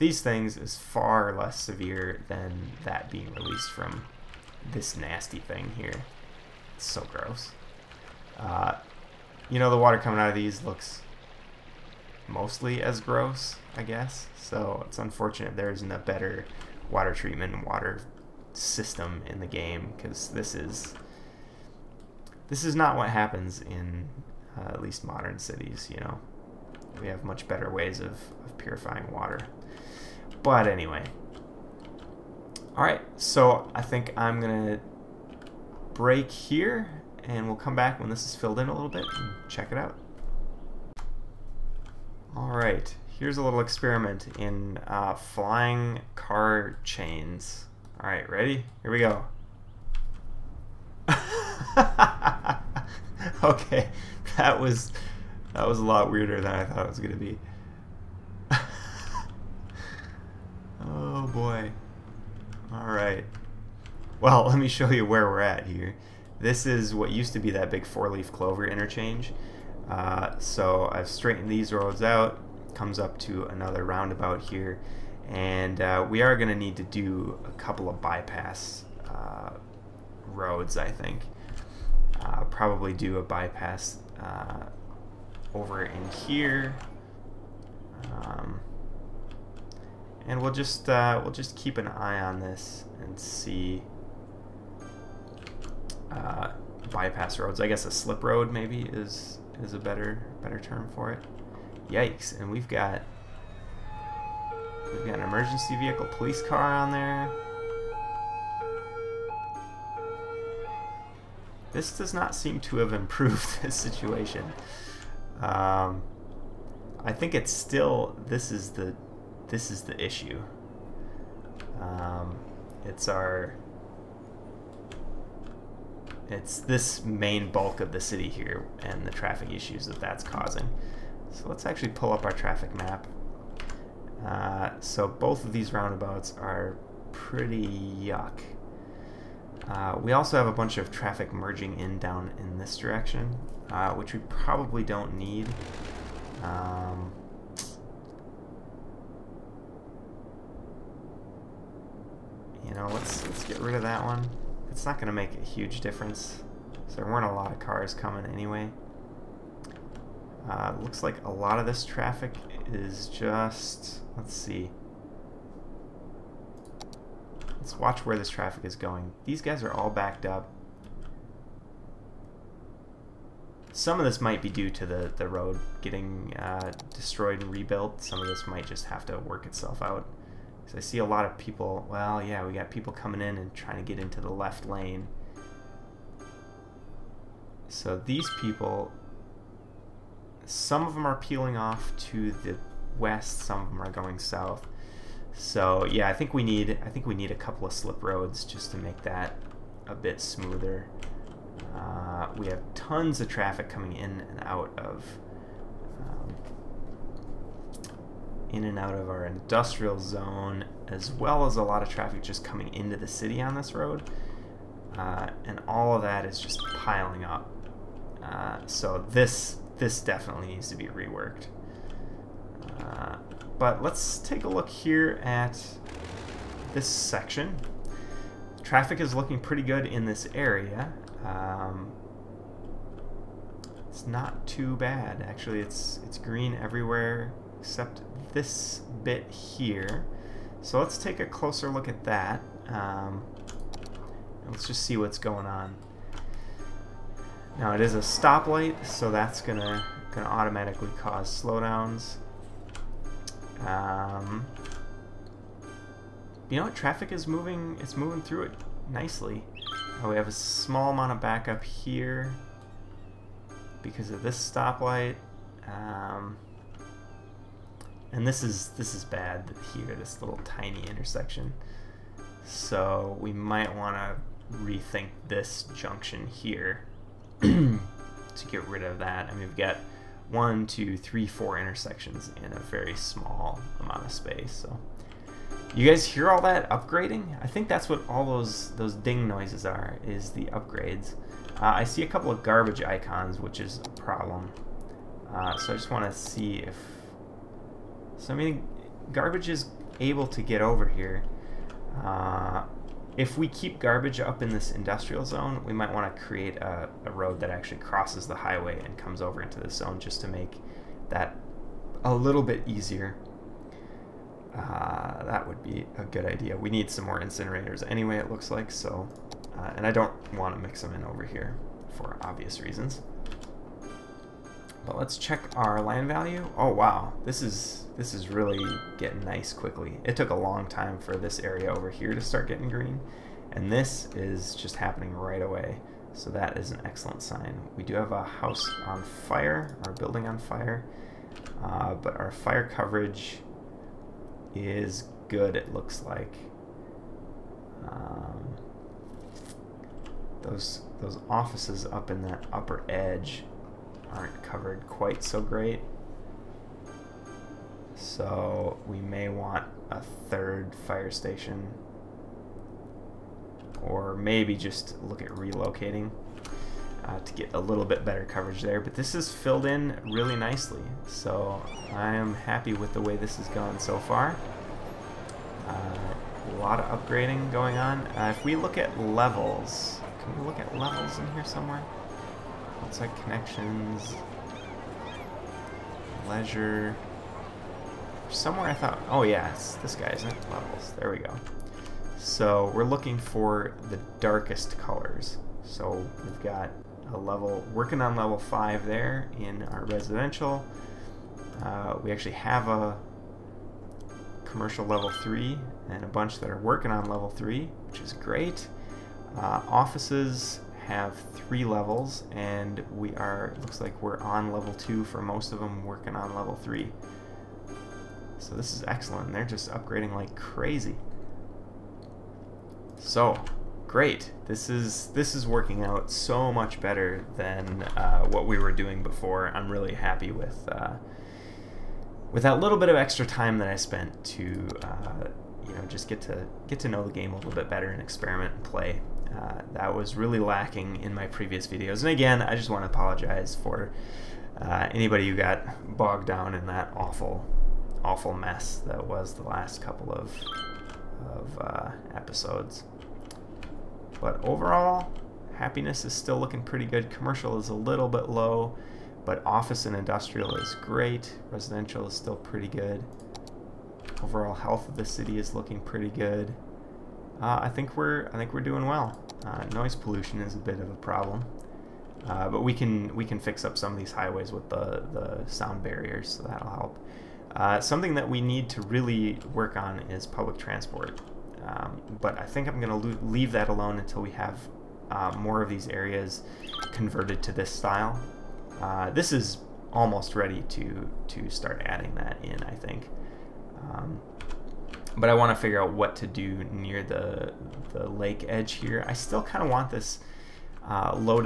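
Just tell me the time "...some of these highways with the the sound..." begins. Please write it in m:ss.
7:53.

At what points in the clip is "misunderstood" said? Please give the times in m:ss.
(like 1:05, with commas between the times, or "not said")
not said.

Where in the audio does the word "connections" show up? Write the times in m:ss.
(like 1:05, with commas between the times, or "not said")
6:23.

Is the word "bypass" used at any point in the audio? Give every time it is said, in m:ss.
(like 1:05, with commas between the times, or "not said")
1:18, 1:23, 1:36.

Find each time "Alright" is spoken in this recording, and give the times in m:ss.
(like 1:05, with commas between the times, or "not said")
0:32, 0:42, 0:48, 1:02.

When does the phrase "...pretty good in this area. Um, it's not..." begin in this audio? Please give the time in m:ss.
3:49.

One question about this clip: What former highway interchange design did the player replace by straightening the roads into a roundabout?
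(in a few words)
Four-leaf clover.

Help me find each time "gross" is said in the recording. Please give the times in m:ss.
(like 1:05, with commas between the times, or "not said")
0:07, 0:13.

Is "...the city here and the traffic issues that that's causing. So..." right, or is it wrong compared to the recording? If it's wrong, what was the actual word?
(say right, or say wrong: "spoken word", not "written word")
right.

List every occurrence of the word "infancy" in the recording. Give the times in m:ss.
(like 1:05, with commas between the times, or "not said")
not said.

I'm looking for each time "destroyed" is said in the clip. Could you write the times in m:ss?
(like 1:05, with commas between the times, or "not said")
2:56.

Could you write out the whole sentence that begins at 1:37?
I guess a slip road maybe is is a better better term for it.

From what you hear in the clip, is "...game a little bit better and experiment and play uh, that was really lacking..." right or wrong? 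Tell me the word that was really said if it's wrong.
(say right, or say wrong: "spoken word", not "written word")
right.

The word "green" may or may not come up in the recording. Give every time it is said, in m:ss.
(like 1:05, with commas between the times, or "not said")
3:56, 5:32.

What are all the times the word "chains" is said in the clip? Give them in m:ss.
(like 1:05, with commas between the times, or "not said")
0:46.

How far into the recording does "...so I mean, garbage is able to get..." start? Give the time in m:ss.
4:58.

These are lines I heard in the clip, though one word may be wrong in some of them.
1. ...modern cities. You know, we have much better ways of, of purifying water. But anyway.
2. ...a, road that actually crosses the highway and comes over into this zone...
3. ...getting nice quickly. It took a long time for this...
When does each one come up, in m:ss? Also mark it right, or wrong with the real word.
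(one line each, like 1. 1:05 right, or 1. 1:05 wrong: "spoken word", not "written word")
1. 0:25 right
2. 5:07 right
3. 5:28 right.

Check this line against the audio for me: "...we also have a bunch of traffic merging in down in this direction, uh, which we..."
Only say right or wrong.
right.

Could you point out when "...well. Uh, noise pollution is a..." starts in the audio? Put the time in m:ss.
7:48.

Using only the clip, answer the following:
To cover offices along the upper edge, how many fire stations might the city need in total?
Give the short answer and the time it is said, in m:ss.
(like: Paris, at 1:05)
3, at 6:00.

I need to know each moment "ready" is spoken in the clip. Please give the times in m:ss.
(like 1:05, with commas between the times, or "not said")
0:48, 8:10.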